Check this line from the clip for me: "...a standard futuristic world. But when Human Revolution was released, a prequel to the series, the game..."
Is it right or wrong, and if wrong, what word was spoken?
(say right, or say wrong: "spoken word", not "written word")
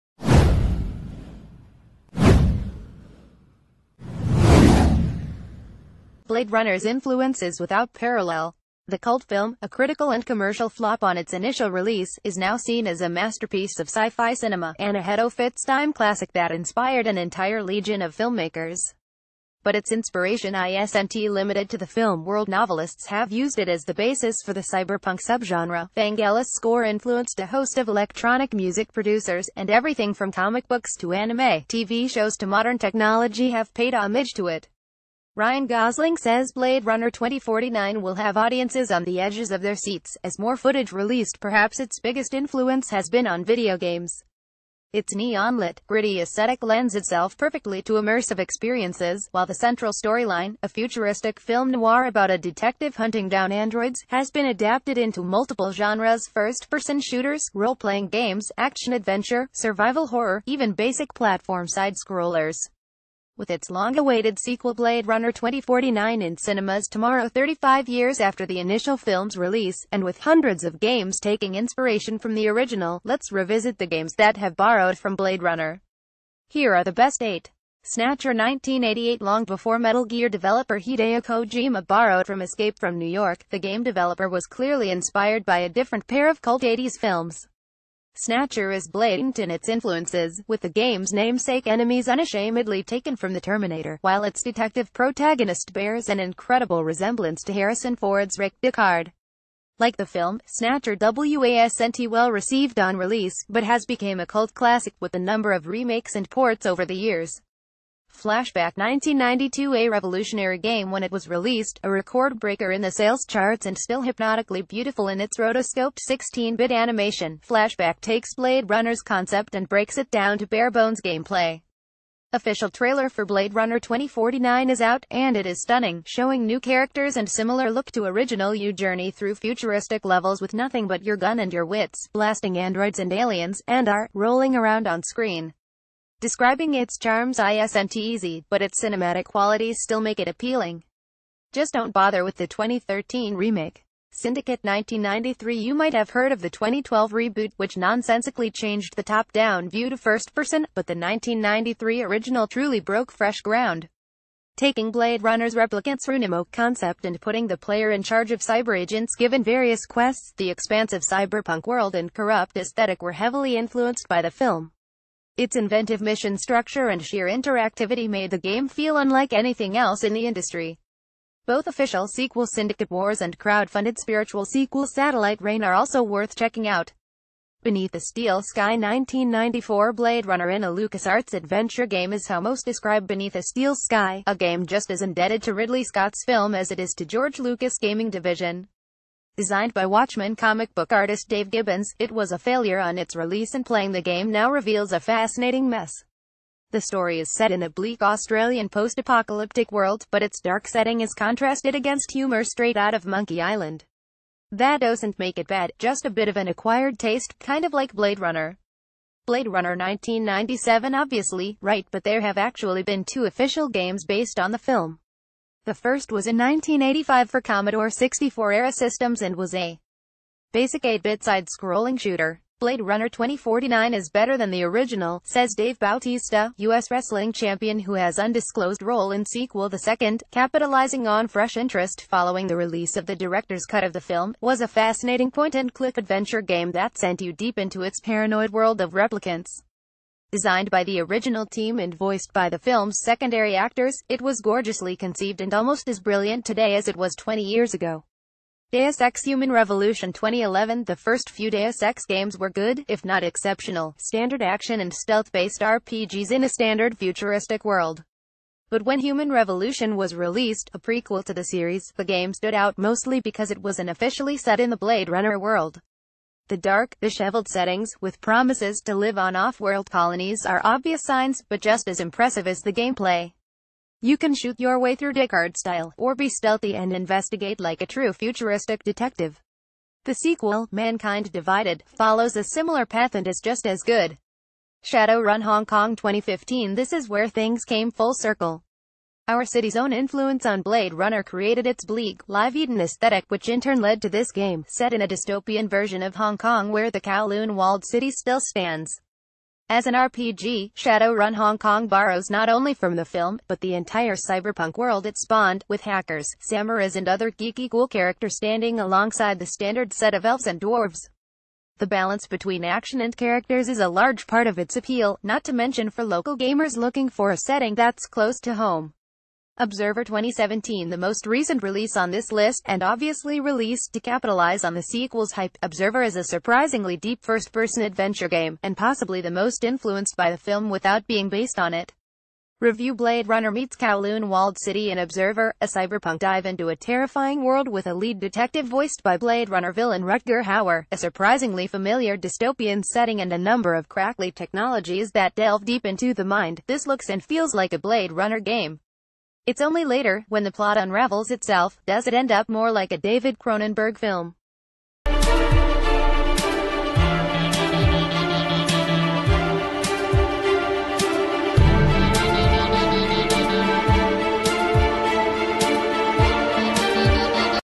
right.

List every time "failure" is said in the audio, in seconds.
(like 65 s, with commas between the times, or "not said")
192 s.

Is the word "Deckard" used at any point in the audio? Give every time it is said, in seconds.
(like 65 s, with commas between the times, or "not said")
98 s, 275 s.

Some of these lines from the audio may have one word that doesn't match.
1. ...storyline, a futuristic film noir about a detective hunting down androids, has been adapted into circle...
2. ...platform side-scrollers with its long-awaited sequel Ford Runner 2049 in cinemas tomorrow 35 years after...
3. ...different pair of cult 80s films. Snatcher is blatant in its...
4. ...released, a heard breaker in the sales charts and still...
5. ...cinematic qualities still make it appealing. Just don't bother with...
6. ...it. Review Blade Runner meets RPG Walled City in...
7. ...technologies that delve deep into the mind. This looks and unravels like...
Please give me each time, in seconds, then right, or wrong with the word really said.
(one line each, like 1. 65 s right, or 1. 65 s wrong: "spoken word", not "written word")
1. 49 s wrong: "multiple", not "circle"
2. 61 s wrong: "Blade", not "Ford"
3. 85 s right
4. 111 s wrong: "record", not "heard"
5. 138 s right
6. 331 s wrong: "Kowloon", not "RPG"
7. 344 s wrong: "feels", not "unravels".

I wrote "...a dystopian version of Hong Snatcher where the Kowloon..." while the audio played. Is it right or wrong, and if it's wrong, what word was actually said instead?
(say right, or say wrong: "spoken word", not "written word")
wrong: "Kong", not "Snatcher".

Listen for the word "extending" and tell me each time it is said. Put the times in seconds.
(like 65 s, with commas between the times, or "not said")
not said.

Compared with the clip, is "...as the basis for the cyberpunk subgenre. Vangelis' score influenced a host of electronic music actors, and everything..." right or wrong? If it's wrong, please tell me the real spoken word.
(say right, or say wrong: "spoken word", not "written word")
wrong: "producers", not "actors".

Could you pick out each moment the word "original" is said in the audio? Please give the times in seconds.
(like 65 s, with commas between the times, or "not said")
72 s, 128 s, 152 s, 224 s, 241 s.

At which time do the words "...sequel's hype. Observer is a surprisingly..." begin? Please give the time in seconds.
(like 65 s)
324 s.